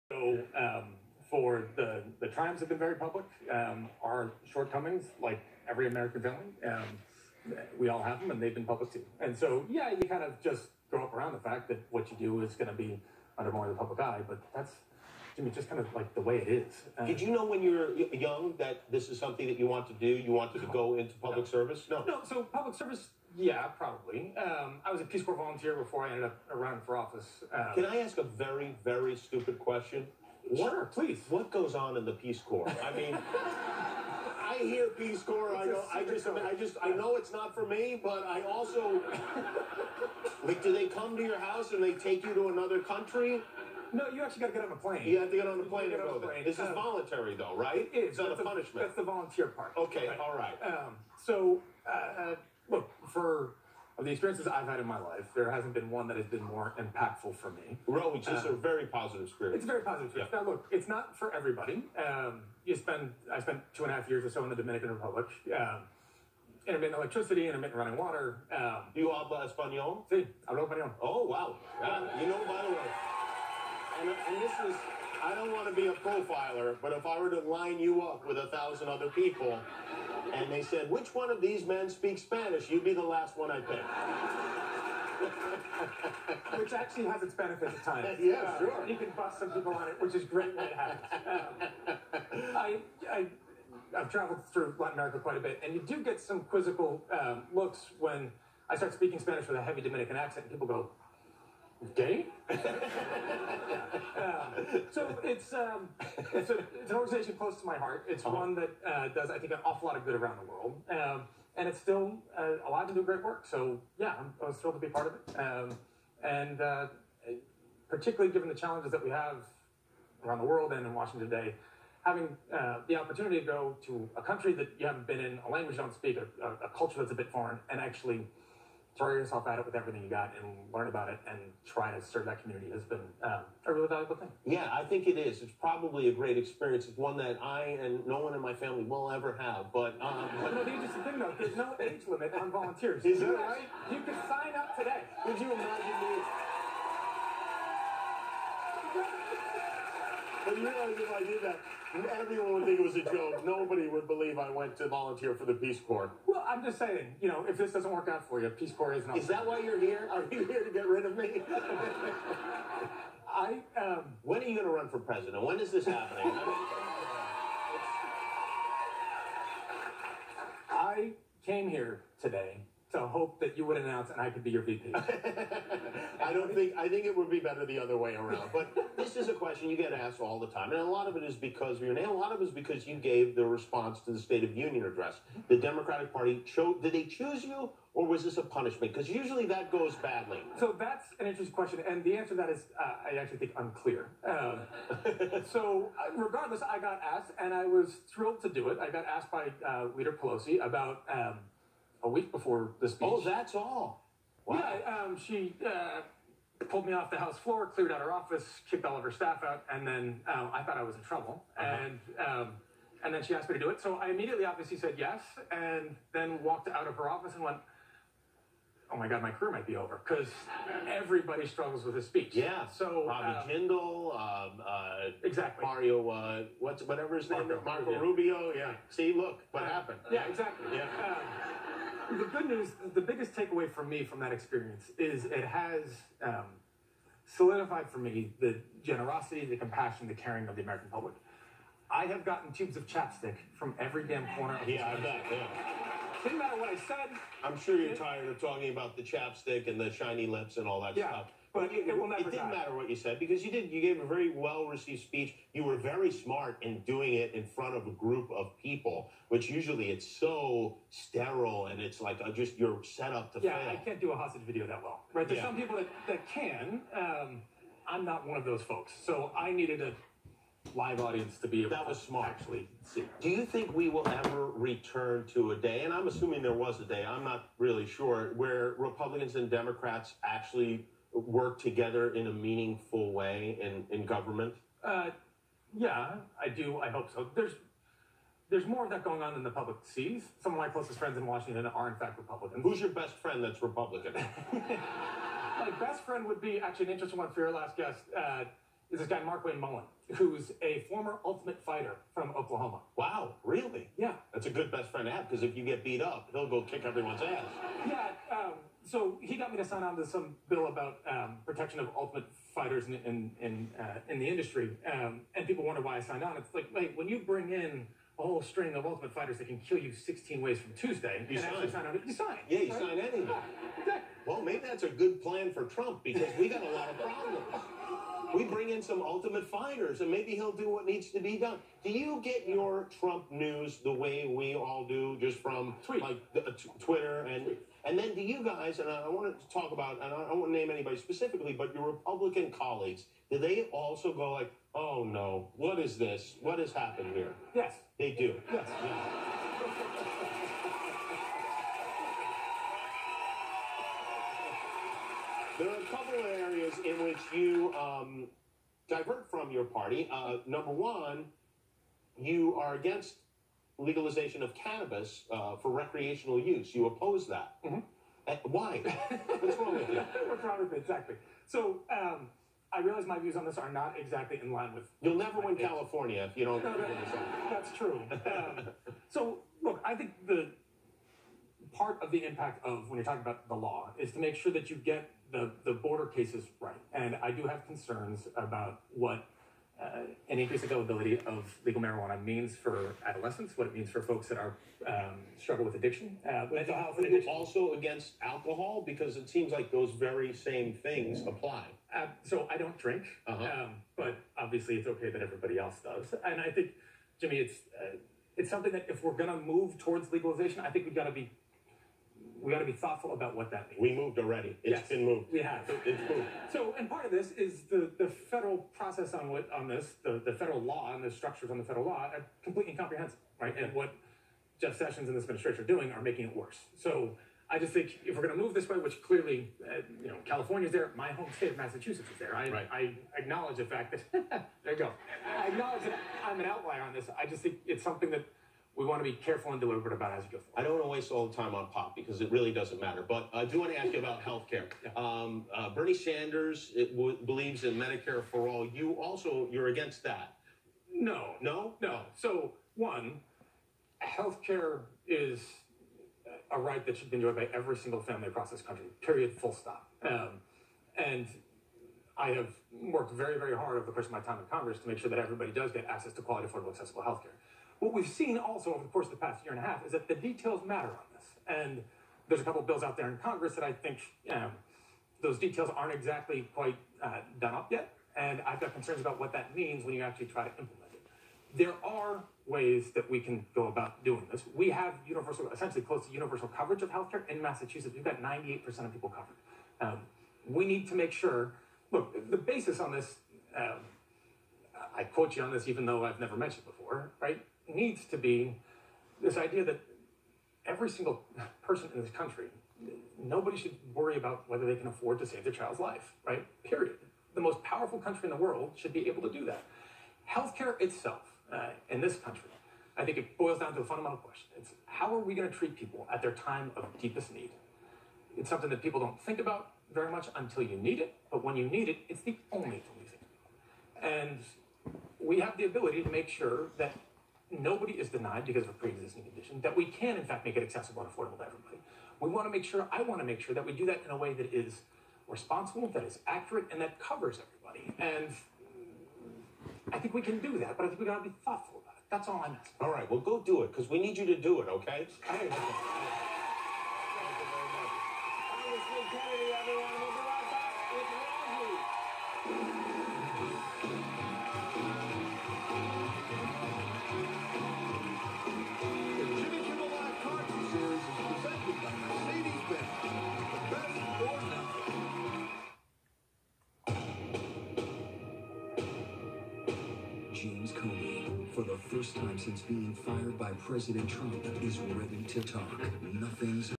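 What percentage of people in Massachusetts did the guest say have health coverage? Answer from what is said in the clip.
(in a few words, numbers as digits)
98%.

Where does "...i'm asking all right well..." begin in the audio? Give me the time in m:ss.
9:02.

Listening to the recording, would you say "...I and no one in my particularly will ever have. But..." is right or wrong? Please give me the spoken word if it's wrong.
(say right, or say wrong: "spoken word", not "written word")
wrong: "family", not "particularly".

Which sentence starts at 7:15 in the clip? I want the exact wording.
I acknowledge that I'm an outlier on this.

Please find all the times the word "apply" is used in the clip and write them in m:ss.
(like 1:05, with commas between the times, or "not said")
6:41.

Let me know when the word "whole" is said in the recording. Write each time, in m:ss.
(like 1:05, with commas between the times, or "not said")
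5:18.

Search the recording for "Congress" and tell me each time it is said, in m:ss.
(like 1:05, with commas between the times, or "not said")
7:44, 7:53.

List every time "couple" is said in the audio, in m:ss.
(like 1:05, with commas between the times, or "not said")
5:55, 7:52.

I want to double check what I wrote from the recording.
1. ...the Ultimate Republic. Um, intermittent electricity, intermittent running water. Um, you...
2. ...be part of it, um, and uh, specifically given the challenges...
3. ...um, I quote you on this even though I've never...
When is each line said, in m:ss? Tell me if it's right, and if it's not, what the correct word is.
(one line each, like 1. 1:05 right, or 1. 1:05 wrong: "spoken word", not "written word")
1. 1:04 wrong: "Dominican", not "Ultimate"
2. 1:54 wrong: "particularly", not "specifically"
3. 8:13 right.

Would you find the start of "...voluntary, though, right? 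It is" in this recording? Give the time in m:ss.
0:46.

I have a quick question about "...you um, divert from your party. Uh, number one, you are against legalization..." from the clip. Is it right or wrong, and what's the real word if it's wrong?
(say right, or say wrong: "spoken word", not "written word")
right.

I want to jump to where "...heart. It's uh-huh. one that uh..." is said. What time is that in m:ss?
1:47.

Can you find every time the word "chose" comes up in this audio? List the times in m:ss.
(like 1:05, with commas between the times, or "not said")
3:06.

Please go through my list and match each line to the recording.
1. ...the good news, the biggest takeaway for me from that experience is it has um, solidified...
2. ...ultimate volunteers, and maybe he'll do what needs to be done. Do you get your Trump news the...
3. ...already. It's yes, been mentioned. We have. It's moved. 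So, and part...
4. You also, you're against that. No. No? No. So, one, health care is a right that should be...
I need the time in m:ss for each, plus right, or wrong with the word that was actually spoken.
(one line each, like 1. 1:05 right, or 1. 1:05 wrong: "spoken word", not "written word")
1. 3:52 right
2. 5:29 wrong: "fighters", not "volunteers"
3. 6:54 wrong: "moved", not "mentioned"
4. 7:28 right.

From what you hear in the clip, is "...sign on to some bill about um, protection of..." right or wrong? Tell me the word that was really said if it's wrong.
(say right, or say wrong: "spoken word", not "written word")
right.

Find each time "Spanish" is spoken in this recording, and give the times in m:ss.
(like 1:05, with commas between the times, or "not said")
1:22, 1:39.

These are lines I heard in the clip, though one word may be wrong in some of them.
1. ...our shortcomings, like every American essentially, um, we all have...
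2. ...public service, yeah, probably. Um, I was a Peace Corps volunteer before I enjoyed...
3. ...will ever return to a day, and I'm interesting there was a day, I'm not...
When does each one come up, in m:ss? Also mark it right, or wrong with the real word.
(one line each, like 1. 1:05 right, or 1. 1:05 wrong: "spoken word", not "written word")
1. 0:04 wrong: "family", not "essentially"
2. 0:22 wrong: "ended", not "enjoyed"
3. 4:33 wrong: "assuming", not "interesting".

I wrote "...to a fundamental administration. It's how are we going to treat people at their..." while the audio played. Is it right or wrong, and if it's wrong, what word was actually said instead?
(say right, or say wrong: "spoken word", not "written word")
wrong: "question", not "administration".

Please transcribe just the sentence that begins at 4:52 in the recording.
Who's your best friend that's Republican?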